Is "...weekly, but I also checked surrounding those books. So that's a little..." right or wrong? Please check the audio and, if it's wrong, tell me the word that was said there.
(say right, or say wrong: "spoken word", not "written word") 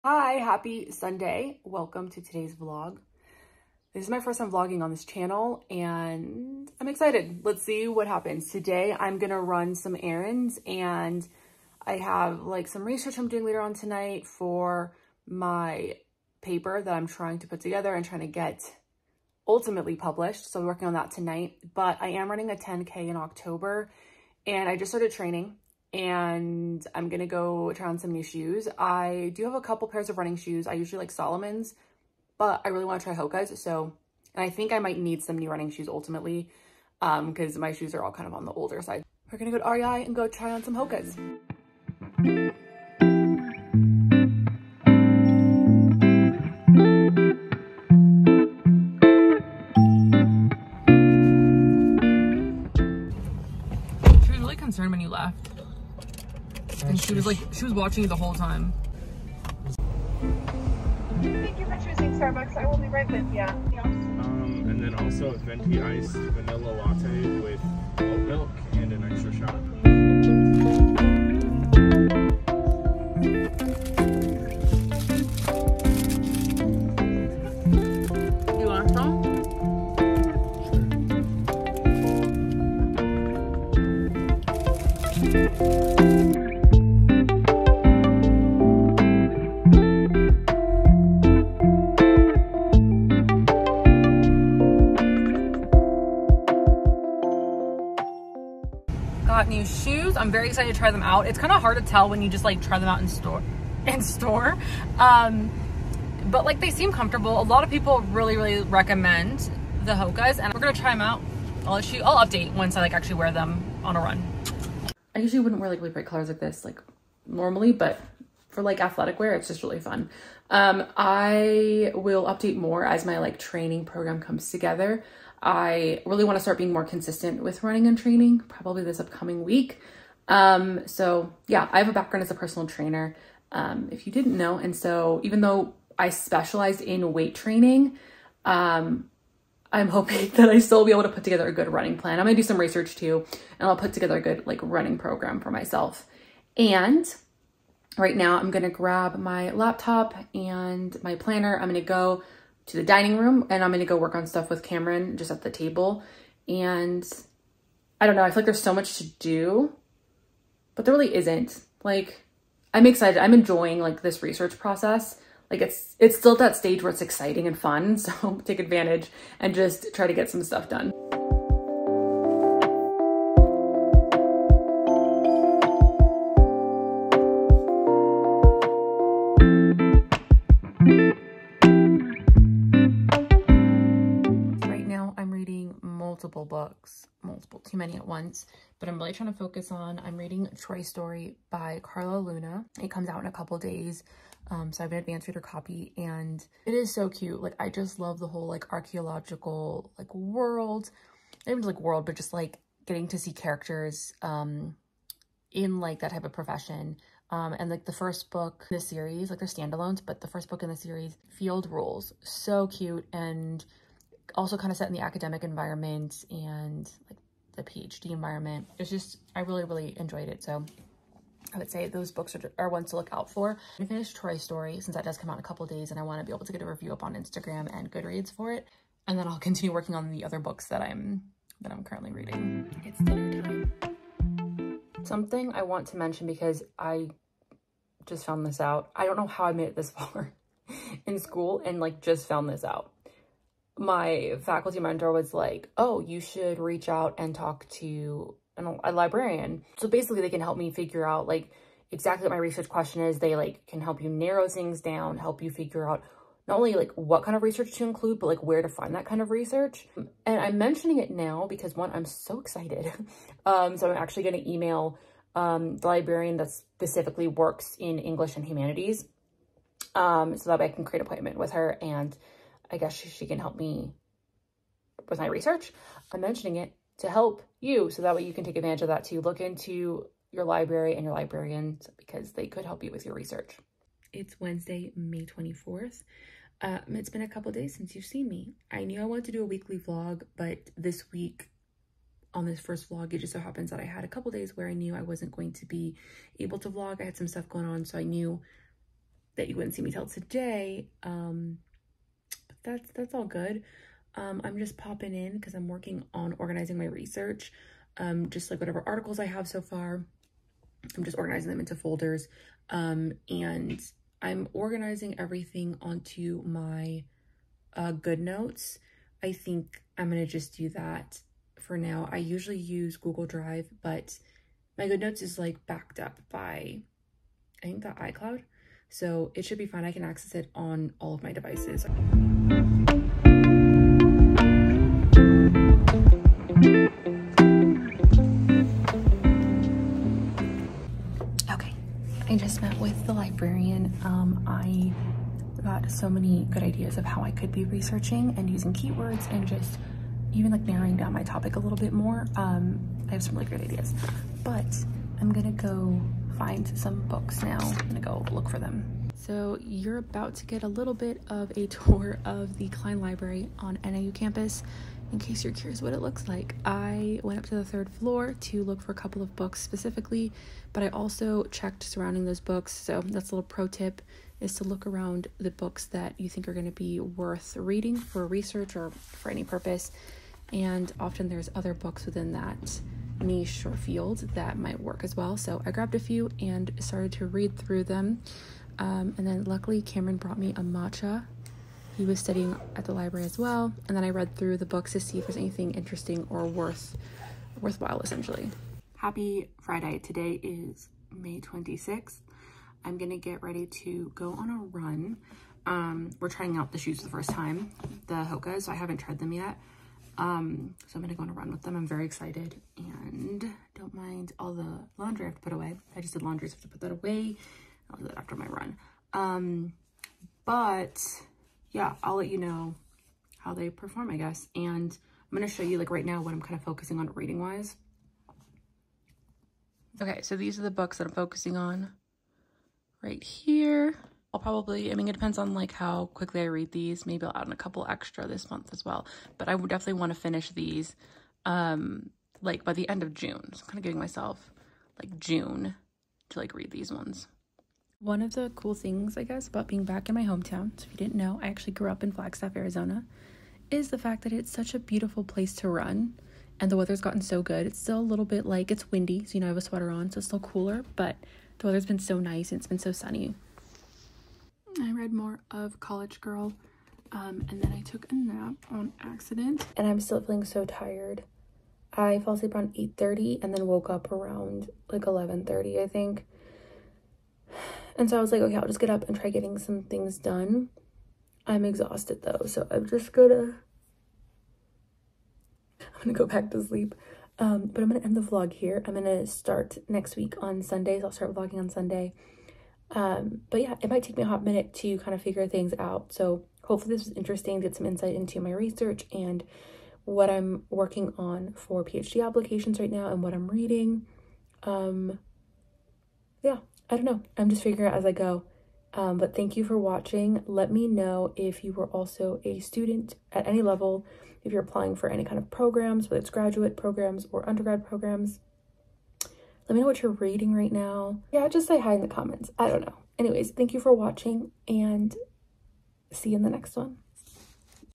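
wrong: "specifically", not "weekly".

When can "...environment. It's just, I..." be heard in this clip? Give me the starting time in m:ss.
3:38.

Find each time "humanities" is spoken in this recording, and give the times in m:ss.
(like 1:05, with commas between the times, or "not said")
4:28.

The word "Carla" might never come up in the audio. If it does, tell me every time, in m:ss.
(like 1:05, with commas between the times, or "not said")
3:11.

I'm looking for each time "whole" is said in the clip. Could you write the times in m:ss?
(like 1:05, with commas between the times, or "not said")
0:58, 3:18.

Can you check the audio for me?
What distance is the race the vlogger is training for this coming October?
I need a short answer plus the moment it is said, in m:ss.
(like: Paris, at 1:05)
10K, at 0:22.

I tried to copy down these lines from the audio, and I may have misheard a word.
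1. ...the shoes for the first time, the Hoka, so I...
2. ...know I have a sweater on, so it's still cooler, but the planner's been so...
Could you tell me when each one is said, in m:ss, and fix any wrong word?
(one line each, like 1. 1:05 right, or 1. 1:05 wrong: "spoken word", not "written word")
1. 6:46 right
2. 7:39 wrong: "weather", not "planner".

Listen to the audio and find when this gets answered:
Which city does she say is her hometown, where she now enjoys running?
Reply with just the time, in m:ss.
7:32.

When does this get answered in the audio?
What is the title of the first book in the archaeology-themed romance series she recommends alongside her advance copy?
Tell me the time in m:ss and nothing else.
3:31.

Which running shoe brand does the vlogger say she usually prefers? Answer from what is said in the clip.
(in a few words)
Salomon.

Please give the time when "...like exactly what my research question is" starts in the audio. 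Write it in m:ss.
4:11.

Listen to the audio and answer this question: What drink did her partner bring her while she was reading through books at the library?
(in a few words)
matcha.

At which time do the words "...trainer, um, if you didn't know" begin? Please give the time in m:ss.
2:12.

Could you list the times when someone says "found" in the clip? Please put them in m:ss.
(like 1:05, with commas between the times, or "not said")
3:58, 4:02.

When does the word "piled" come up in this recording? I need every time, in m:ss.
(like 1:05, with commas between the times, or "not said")
not said.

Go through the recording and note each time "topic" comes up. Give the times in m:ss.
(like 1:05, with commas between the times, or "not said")
5:51.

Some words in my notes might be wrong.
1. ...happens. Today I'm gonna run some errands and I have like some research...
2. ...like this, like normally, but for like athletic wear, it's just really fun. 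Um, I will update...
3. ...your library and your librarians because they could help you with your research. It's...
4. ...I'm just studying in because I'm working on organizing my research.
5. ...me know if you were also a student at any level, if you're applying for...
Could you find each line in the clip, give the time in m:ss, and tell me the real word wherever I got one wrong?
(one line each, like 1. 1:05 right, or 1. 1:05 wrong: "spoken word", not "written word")
1. 0:08 right
2. 1:56 right
3. 4:40 right
4. 5:04 wrong: "popping", not "studying"
5. 8:30 right.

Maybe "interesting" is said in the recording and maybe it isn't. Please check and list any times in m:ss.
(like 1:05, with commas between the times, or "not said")
6:35, 8:17.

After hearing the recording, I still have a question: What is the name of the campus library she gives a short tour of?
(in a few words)
Cline Library.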